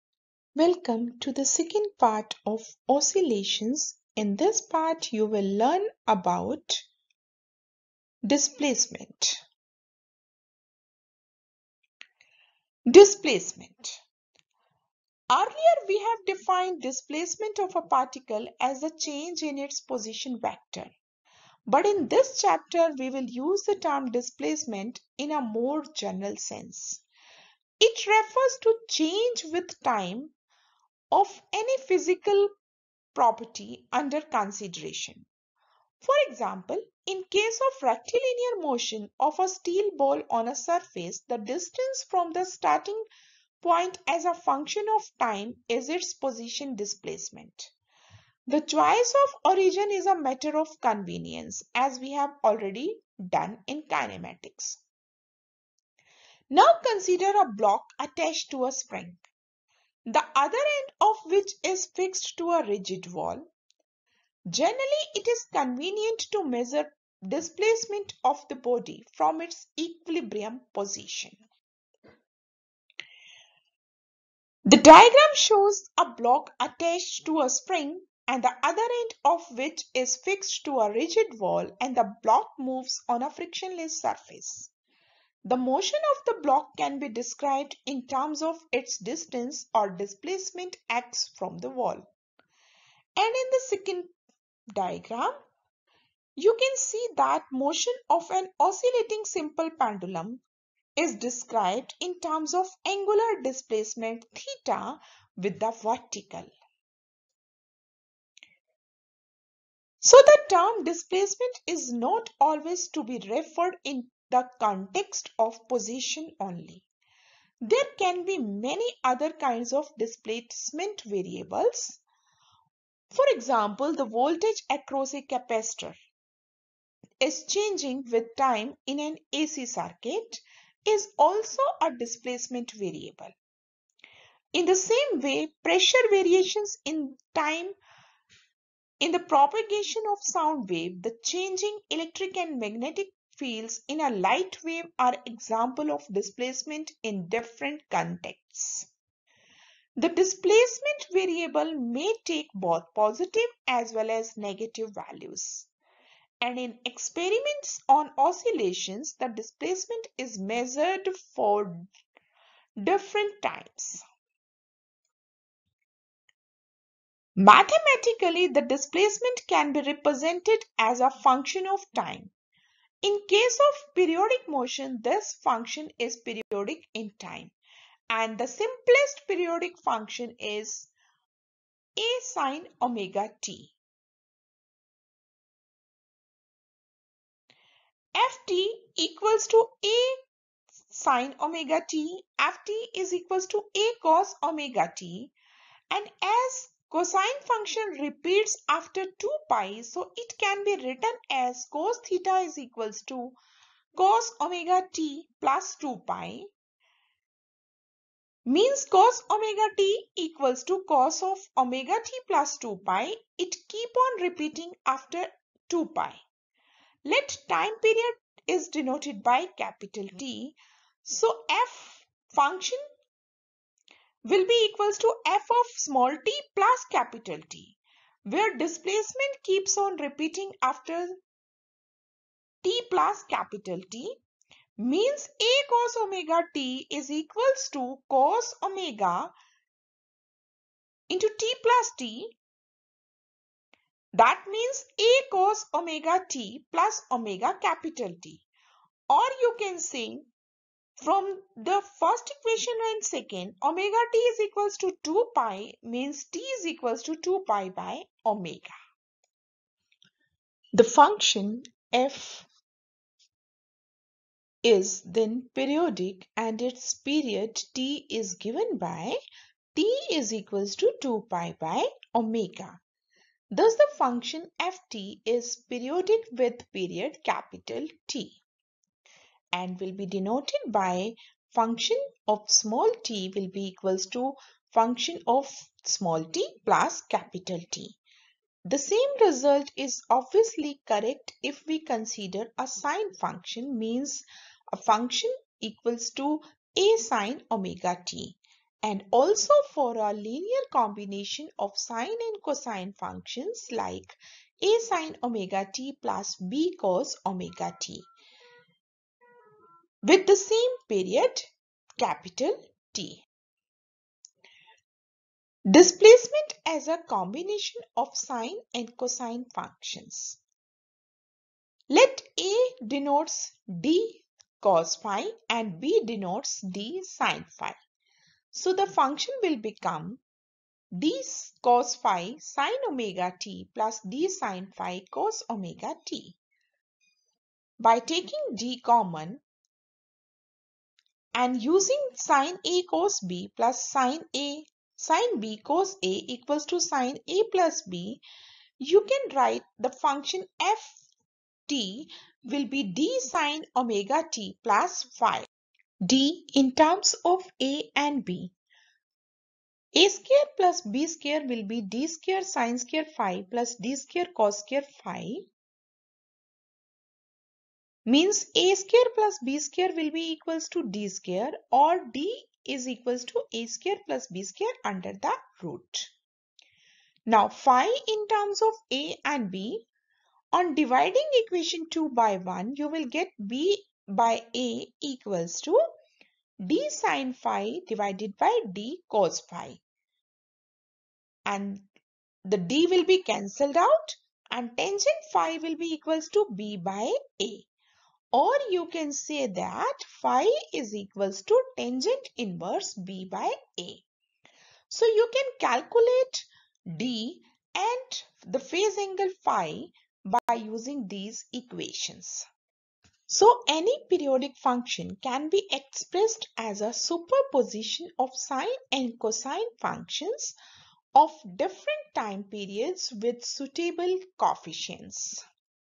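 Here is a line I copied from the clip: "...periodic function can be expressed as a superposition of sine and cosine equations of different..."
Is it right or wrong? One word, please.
wrong.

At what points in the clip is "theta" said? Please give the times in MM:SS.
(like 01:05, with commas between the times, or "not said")
01:44, 03:22.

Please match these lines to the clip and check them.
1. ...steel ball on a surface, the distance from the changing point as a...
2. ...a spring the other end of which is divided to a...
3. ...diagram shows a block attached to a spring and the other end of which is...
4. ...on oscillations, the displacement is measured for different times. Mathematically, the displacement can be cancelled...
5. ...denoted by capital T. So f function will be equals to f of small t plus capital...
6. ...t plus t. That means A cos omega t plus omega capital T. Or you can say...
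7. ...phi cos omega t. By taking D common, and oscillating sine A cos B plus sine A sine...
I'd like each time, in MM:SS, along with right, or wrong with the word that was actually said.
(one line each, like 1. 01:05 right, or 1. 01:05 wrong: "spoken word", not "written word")
1. 00:39 wrong: "starting", not "changing"
2. 00:58 wrong: "fixed", not "divided"
3. 01:14 right
4. 02:37 wrong: "represented", not "cancelled"
5. 03:38 right
6. 04:01 right
7. 05:34 wrong: "using", not "oscillating".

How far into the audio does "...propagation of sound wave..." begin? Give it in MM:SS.
02:19.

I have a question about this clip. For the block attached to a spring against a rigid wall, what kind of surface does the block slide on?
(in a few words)
frictionless surface.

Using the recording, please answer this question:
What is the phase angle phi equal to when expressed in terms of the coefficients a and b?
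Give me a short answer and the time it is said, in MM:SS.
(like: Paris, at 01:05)
tangent inverse b by a, at 06:41.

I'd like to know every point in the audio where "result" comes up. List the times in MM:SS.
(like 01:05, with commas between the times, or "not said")
04:49.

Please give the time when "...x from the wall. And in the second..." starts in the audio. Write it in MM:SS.
01:30.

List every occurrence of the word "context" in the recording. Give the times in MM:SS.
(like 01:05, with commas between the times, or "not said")
01:54, 02:27.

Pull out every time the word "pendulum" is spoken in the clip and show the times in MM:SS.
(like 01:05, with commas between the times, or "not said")
01:39.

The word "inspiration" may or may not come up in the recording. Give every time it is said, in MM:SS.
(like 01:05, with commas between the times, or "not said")
not said.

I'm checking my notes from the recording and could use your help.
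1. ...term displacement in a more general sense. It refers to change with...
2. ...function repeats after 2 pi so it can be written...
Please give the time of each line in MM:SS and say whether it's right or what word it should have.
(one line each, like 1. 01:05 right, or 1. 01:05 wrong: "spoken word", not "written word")
1. 00:23 right
2. 03:17 right.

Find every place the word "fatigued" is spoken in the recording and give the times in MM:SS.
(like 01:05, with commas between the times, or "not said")
not said.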